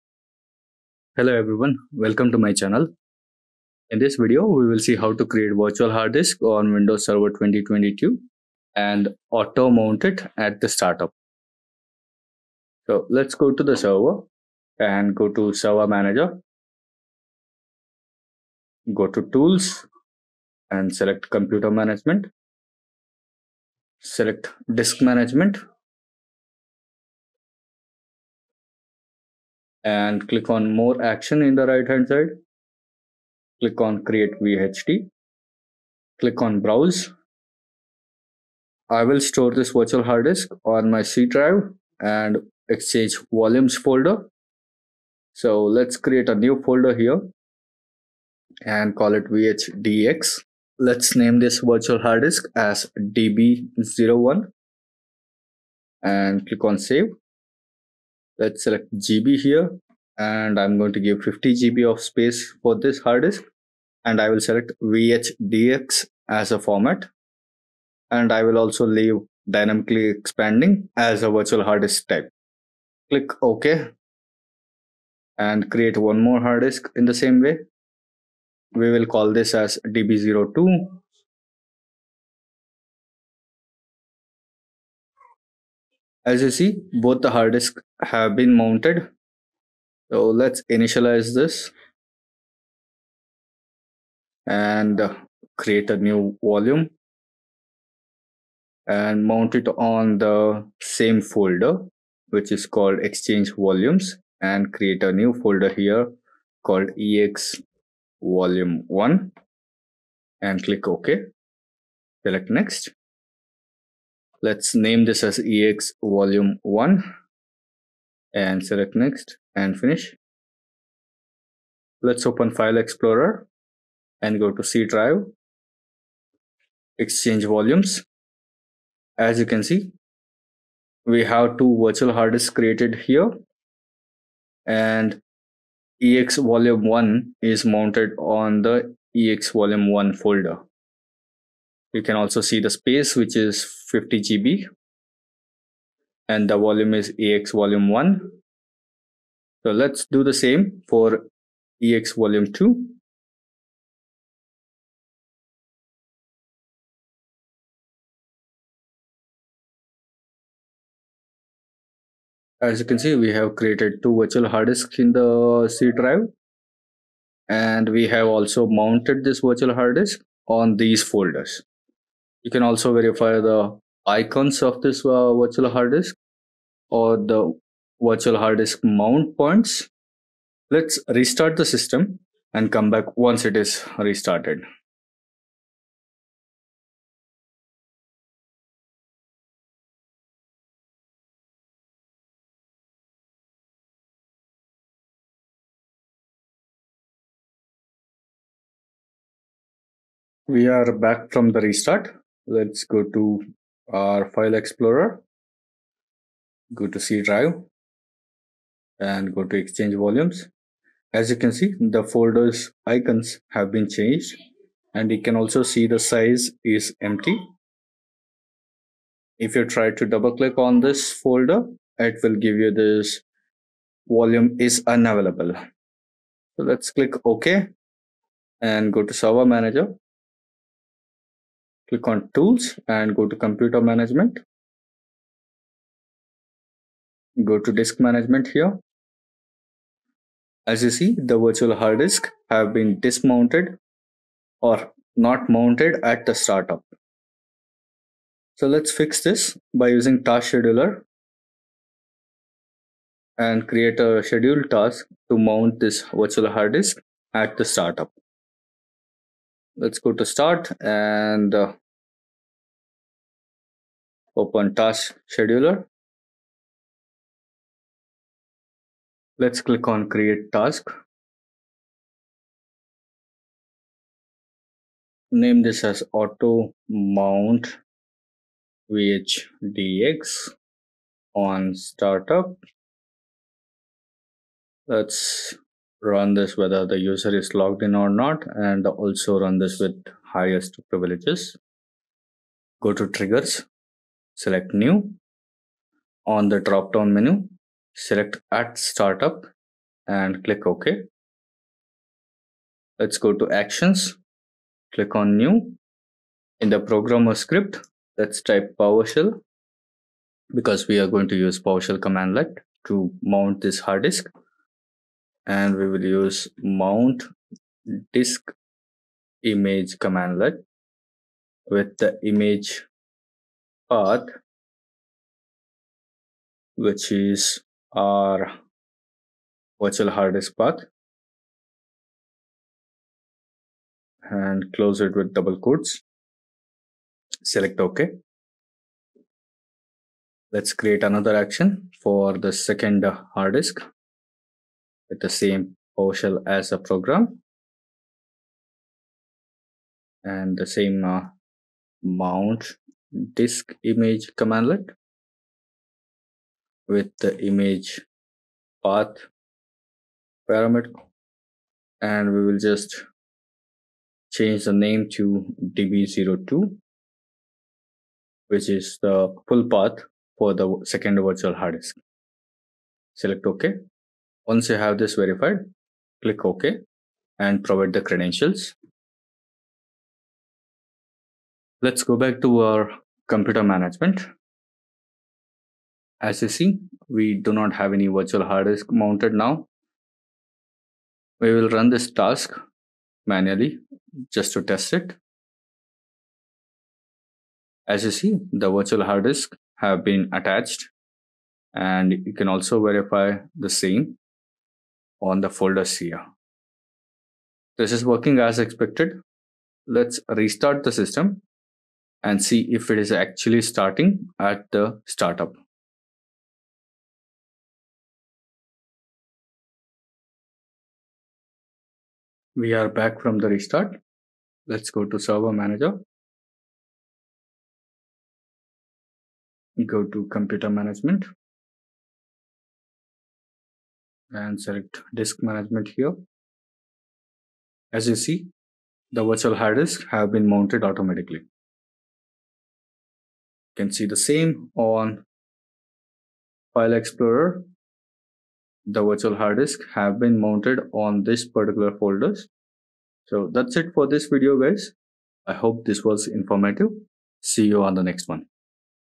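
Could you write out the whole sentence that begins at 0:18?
Go to tools and select computer management.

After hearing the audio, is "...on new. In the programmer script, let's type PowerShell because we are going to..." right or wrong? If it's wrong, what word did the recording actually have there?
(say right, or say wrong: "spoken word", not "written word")
right.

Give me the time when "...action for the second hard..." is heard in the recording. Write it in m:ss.
5:41.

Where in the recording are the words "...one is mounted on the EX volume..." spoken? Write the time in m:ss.
2:16.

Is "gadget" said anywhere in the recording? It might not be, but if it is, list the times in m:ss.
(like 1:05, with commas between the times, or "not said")
not said.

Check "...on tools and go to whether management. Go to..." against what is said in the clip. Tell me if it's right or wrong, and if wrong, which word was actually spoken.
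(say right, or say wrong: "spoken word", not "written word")
wrong: "computer", not "whether".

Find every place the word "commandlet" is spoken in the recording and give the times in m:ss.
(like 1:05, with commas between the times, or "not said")
5:11, 5:19, 5:54.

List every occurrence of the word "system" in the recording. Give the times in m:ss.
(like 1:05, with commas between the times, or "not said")
3:01, 6:50.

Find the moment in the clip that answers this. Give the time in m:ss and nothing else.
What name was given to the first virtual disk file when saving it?
0:52.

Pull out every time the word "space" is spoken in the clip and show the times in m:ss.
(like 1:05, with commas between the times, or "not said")
1:01, 2:22.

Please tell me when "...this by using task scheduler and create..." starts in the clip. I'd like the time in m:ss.
4:09.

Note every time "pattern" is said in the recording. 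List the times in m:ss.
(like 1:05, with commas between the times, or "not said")
not said.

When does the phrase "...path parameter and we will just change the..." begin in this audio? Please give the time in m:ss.
5:58.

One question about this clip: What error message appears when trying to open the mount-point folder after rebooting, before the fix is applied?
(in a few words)
This volume is unavailable.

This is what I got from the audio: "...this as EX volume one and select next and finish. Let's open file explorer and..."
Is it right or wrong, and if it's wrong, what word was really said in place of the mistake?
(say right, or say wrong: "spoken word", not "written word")
right.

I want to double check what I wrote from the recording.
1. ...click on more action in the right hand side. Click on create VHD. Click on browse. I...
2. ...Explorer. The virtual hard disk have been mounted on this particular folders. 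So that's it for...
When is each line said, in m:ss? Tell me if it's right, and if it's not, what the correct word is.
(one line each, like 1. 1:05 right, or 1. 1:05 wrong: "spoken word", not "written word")
1. 0:30 right
2. 7:26 right.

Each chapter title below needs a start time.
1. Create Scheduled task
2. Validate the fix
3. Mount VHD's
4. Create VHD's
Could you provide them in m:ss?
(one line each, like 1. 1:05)
1. 3:12
2. 6:30
3. 1:29
4. 0:11.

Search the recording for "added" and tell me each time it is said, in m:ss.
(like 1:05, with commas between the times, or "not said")
not said.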